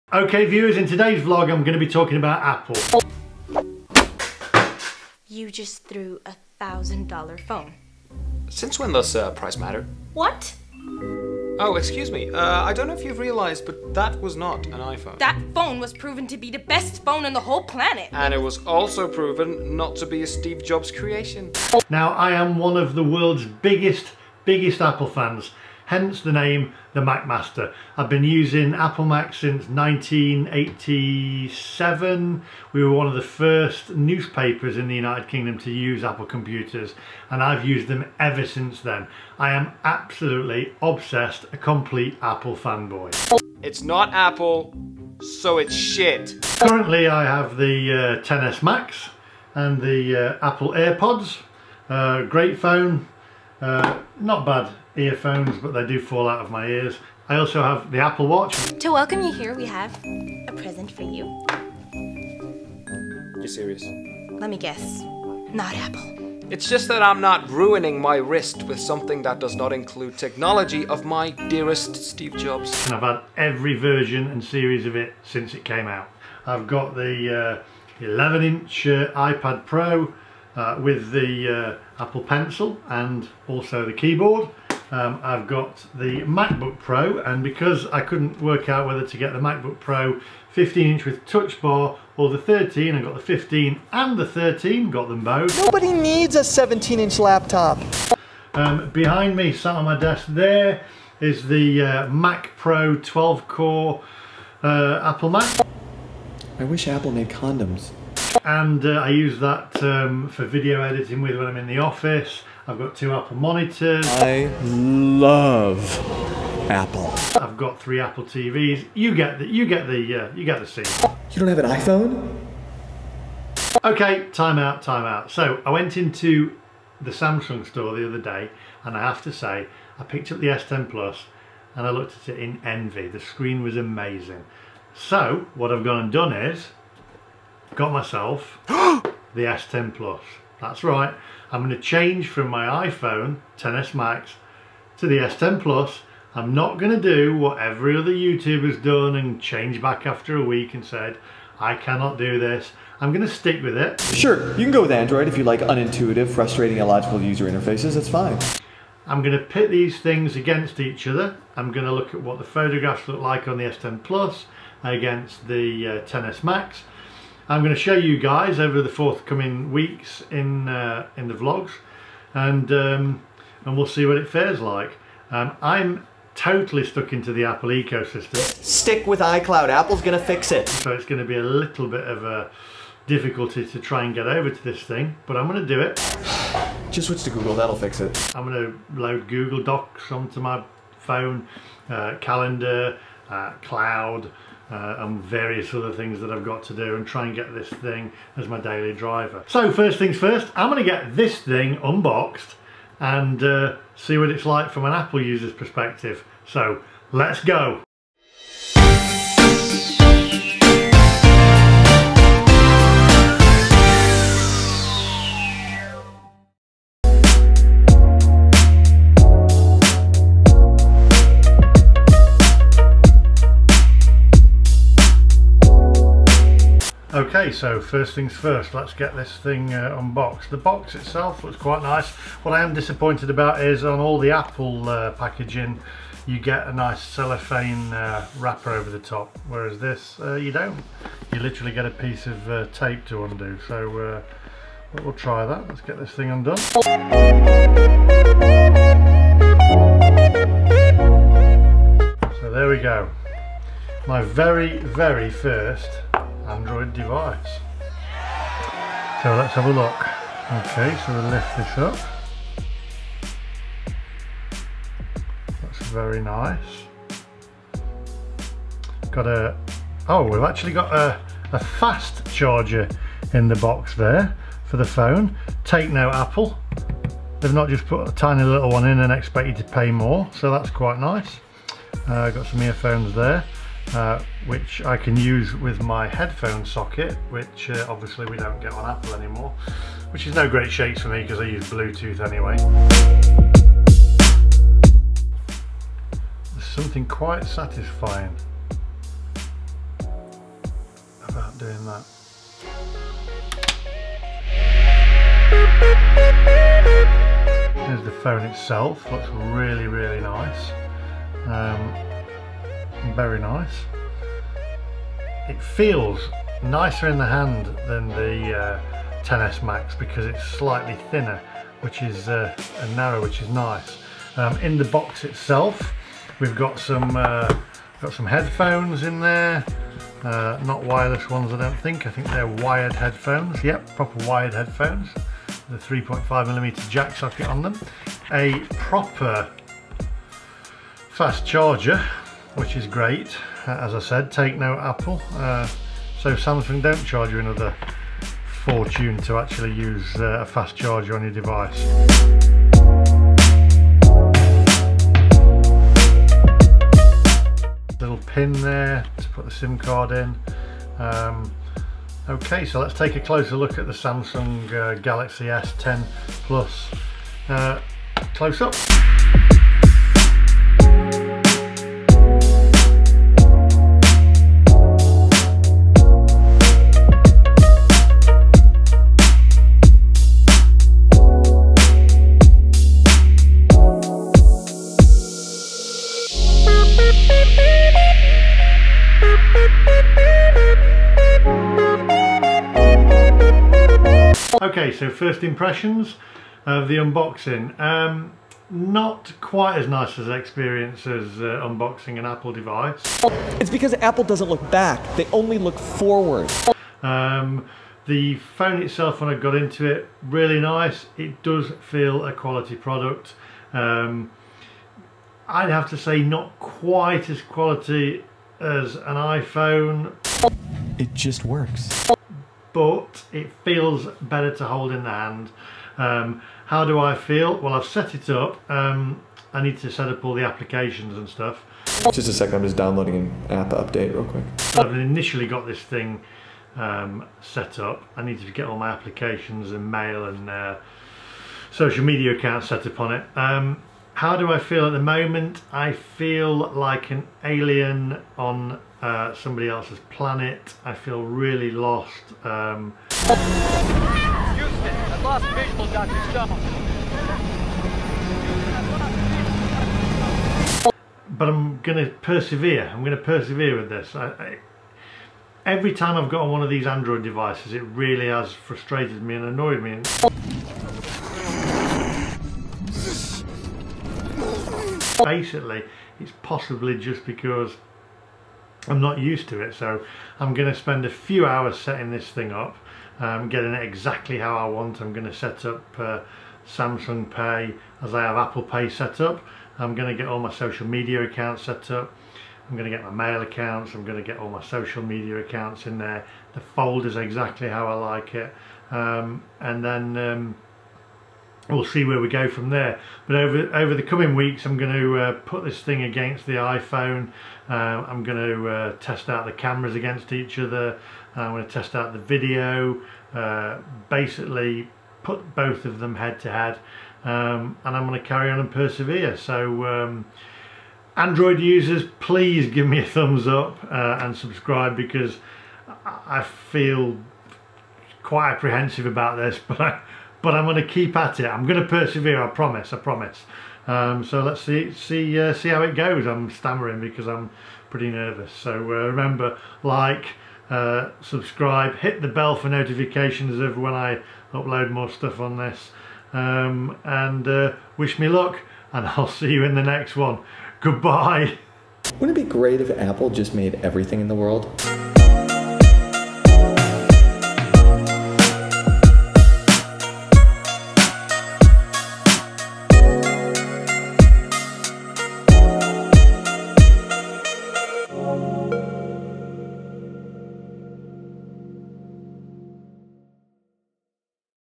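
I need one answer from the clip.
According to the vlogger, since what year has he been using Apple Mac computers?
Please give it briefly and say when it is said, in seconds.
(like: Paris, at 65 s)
1987, at 29 s.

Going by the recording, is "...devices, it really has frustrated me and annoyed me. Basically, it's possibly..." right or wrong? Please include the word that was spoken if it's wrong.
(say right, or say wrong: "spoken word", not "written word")
right.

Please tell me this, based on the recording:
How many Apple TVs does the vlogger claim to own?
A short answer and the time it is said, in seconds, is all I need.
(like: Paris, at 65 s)
3, at 117 s.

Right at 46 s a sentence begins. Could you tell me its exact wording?
Currently I have the uh, 10S Max and the uh, Apple AirPods.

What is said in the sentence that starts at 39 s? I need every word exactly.
I am absolutely obsessed, a complete Apple fanboy.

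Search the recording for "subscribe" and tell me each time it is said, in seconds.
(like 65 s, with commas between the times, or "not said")
524 s, 541 s.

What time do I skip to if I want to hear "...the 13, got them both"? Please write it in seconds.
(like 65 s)
94 s.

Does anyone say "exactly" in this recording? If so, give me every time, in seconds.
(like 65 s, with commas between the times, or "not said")
483 s, 497 s.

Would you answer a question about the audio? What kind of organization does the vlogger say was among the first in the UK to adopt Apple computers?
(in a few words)
newspapers.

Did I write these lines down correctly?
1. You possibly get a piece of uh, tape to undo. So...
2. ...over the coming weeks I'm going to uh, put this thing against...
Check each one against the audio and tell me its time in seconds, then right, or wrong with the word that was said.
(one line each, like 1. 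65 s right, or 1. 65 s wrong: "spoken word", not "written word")
1. 241 s wrong: "literally", not "possibly"
2. 503 s right.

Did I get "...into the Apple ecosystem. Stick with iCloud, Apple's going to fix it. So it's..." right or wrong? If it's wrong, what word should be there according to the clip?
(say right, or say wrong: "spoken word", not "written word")
right.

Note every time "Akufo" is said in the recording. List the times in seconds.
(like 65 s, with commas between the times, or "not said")
not said.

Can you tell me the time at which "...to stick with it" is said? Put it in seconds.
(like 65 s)
153 s.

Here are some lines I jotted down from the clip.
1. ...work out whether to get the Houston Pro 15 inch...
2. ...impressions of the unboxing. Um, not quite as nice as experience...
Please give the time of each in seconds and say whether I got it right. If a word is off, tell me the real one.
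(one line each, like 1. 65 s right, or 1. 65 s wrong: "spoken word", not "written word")
1. 88 s wrong: "MacBook", not "Houston"
2. 395 s right.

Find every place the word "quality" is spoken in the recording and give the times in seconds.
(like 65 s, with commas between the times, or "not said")
412 s, 417 s.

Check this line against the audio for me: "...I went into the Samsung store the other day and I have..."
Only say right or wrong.
right.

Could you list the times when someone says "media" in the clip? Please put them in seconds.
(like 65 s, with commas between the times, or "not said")
442 s, 490 s, 495 s.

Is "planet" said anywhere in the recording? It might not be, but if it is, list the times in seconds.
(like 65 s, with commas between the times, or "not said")
17 s, 450 s.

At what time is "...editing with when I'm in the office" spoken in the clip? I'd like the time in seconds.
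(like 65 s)
110 s.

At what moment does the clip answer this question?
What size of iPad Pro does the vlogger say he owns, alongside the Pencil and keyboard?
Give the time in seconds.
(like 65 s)
78 s.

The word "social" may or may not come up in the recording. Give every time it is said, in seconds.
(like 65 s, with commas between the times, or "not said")
441 s, 490 s, 494 s.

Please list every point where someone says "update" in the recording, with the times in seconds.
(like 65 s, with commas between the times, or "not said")
433 s.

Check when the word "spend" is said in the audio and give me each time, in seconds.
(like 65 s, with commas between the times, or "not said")
480 s.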